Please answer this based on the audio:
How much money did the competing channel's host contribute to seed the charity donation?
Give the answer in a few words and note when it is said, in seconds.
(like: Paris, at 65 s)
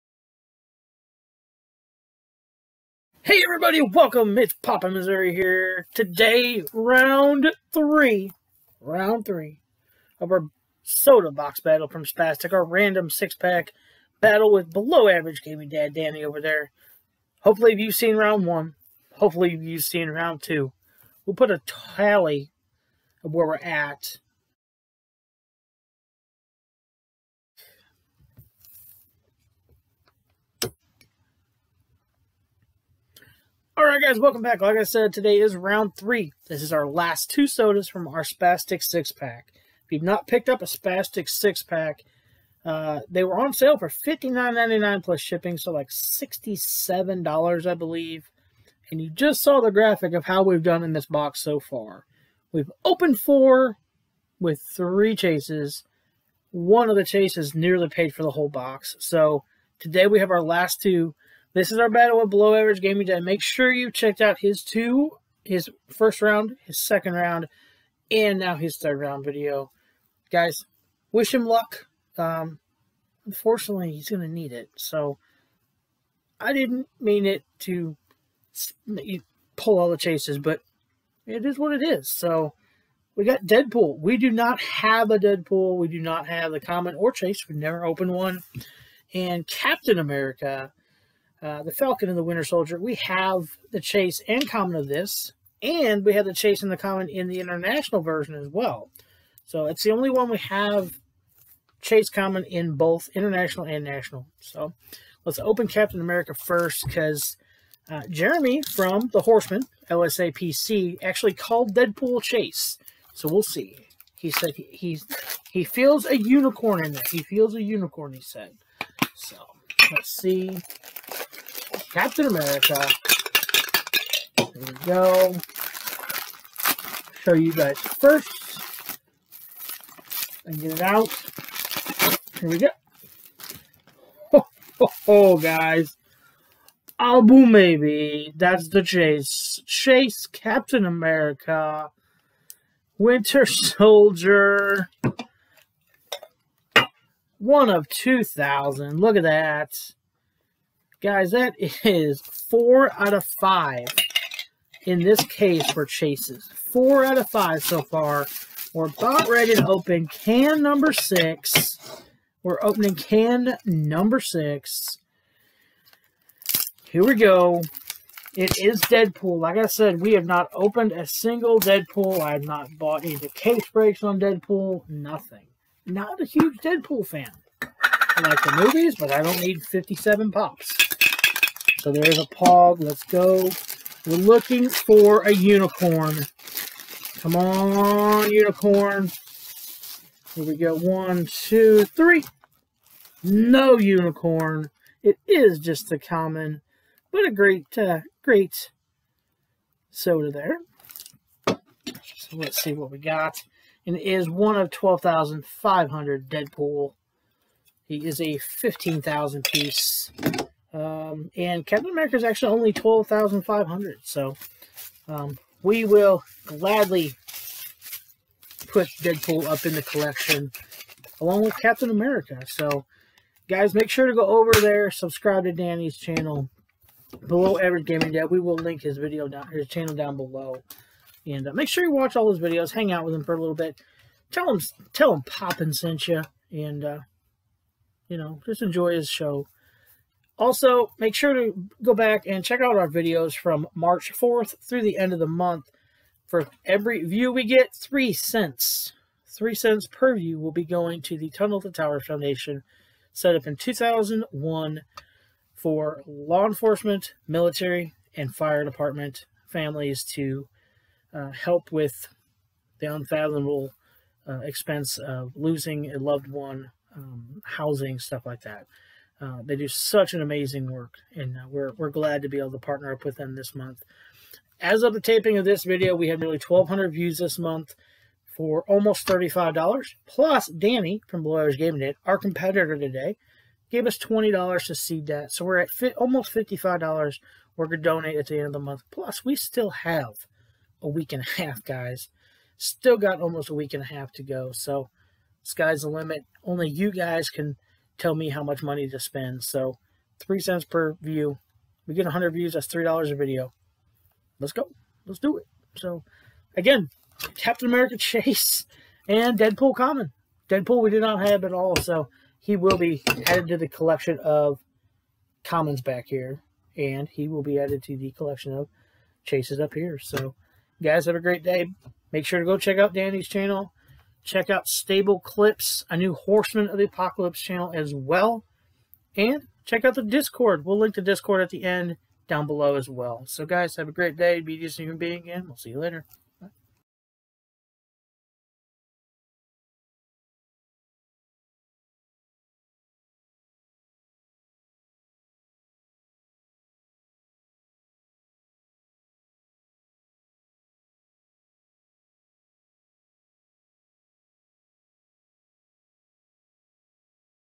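$20, at 283 s.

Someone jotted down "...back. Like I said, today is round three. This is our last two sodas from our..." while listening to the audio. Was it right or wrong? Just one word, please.
right.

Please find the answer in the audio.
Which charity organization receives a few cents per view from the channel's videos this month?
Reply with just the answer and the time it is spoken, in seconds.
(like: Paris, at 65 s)
Tunnel to Towers Foundation, at 251 s.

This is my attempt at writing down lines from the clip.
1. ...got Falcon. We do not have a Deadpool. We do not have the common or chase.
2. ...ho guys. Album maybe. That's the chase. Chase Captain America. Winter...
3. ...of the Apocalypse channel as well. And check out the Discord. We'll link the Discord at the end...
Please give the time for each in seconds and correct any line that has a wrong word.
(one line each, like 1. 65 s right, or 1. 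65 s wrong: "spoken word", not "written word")
1. 83 s wrong: "Deadpool", not "Falcon"
2. 135 s right
3. 326 s right.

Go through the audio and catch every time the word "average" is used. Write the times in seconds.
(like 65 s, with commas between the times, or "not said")
15 s, 62 s, 227 s, 281 s.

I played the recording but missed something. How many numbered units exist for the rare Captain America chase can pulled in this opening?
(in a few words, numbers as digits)
2,000.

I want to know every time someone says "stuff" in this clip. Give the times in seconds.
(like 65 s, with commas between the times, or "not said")
267 s.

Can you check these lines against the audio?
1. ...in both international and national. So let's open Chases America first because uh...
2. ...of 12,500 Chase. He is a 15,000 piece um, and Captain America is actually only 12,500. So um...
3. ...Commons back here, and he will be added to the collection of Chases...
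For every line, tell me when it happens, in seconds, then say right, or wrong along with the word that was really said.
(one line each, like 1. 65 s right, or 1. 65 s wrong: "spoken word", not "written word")
1. 102 s wrong: "Captain", not "Chases"
2. 204 s wrong: "Deadpool", not "Chase"
3. 315 s right.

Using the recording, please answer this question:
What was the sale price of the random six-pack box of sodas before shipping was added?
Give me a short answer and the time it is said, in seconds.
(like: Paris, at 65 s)
$59.99, at 43 s.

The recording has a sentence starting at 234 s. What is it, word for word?
Tell him, tell him Poppin sent you, and uh, you know, just enjoy his show.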